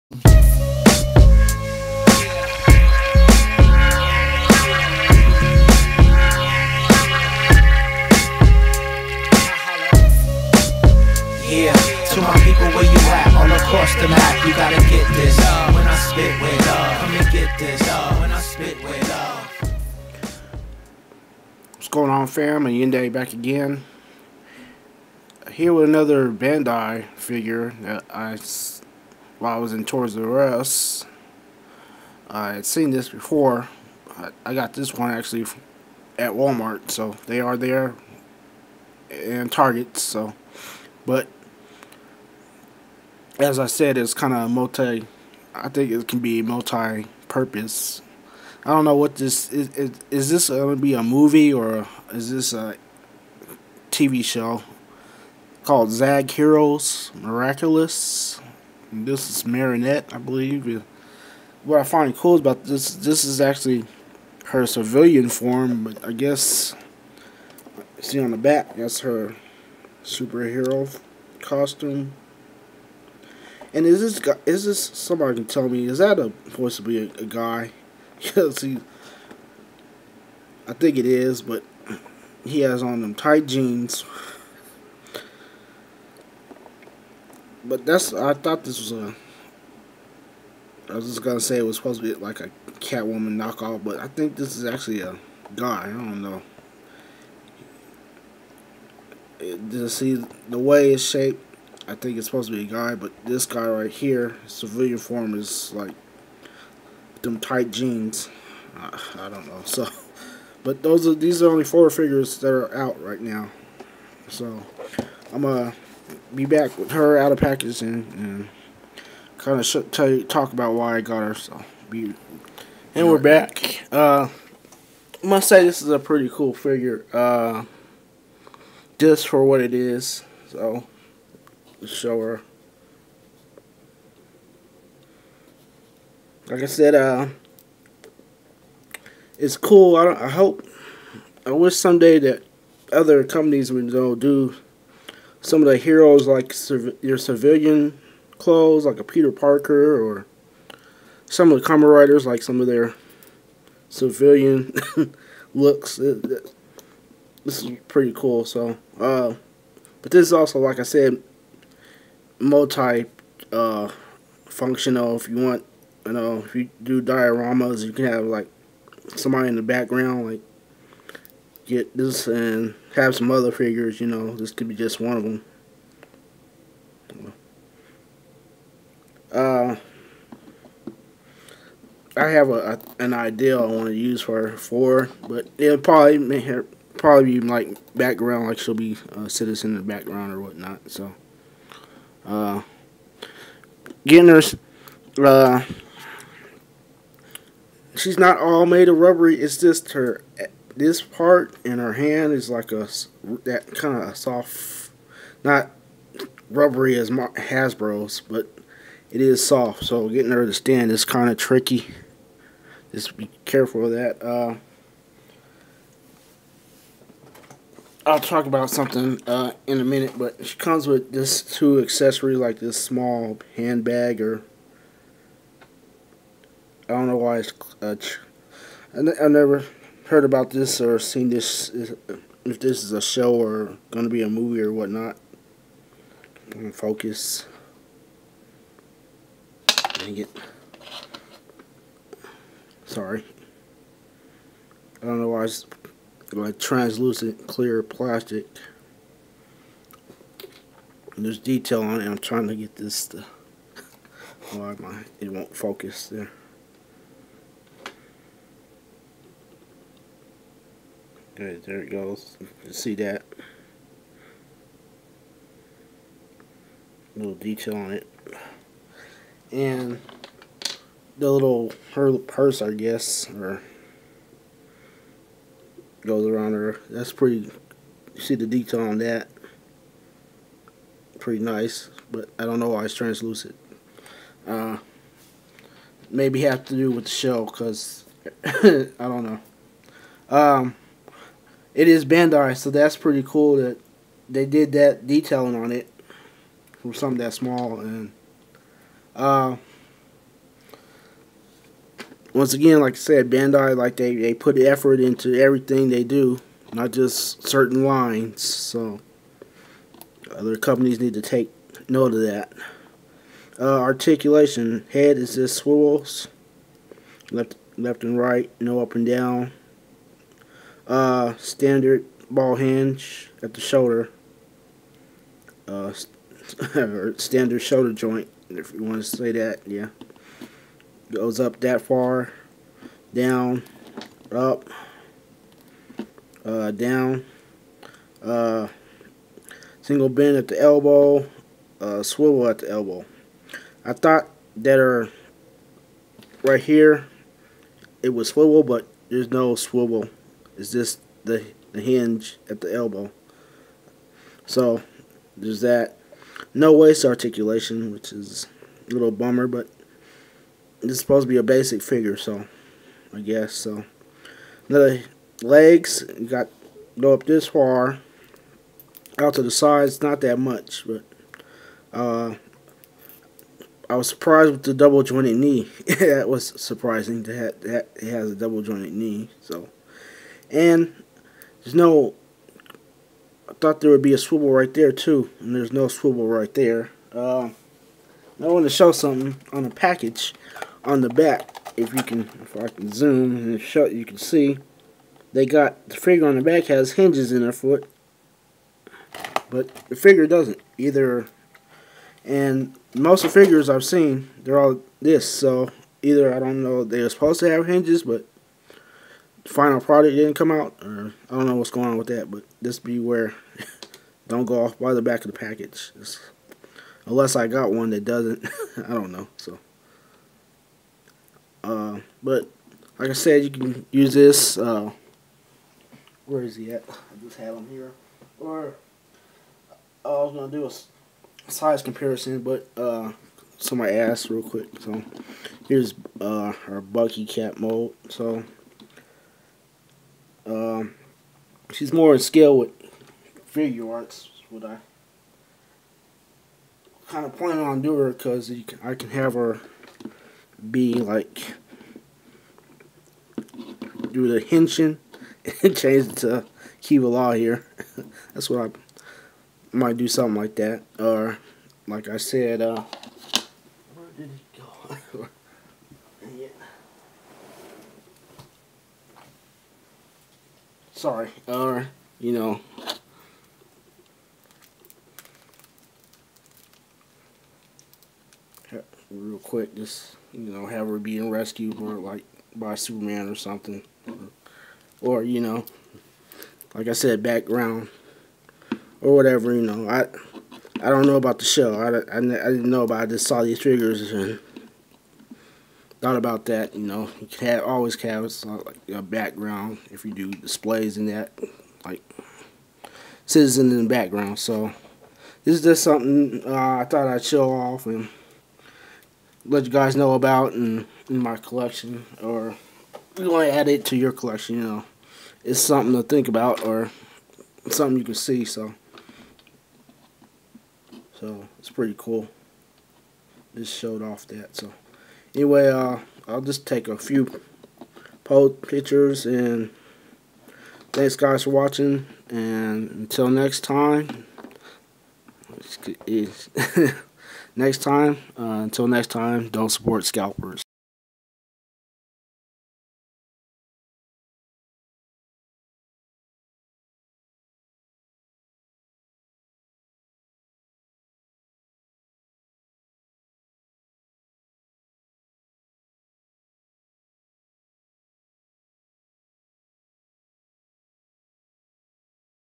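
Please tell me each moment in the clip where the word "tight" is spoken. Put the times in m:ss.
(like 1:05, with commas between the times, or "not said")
1:23, 1:47.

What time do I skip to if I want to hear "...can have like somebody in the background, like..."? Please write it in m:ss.
2:47.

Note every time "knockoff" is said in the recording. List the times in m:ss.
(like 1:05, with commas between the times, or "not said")
1:33.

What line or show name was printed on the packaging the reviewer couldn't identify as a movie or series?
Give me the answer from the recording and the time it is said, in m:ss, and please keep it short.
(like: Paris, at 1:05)
Zag Heroez Miraculous, at 0:55.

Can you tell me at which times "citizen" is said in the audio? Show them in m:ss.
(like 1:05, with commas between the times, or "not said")
3:09, 8:23.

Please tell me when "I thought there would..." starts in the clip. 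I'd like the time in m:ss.
6:23.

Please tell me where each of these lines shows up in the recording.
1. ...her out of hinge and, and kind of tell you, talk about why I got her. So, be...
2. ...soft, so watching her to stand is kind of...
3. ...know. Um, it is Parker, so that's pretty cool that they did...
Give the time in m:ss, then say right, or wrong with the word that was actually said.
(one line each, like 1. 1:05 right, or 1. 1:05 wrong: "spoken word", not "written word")
1. 1:56 wrong: "package", not "hinge"
2. 3:29 wrong: "getting", not "watching"
3. 4:49 wrong: "Bandai", not "Parker".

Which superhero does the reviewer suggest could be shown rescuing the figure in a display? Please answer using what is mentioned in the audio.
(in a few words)
Superman.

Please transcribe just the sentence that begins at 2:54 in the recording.
You know, this could be just one of them.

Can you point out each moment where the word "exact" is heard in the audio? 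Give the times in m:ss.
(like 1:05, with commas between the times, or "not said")
not said.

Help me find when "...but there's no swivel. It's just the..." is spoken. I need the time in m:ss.
5:48.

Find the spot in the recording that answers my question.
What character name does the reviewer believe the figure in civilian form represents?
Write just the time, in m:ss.
0:59.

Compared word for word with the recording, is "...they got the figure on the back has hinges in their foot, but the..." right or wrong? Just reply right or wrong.
right.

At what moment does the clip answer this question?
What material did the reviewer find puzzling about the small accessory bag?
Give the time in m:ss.
4:06.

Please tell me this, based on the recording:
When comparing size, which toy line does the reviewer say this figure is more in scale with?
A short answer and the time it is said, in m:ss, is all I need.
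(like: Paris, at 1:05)
Figuarts, at 7:23.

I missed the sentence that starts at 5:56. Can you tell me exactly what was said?
No waist articulation, which is a little bummer, but it's supposed to be a basic figure, so I guess so.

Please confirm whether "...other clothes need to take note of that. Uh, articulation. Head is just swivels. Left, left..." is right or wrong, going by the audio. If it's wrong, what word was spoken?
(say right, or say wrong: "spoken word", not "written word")
wrong: "companies", not "clothes".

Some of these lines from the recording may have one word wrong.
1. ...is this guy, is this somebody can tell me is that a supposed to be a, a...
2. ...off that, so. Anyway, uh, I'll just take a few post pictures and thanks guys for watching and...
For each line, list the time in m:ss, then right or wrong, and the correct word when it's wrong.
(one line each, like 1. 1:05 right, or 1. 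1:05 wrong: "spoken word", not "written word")
1. 1:13 right
2. 8:44 right.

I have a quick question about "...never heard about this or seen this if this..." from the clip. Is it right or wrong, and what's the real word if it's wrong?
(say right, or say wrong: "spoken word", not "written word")
right.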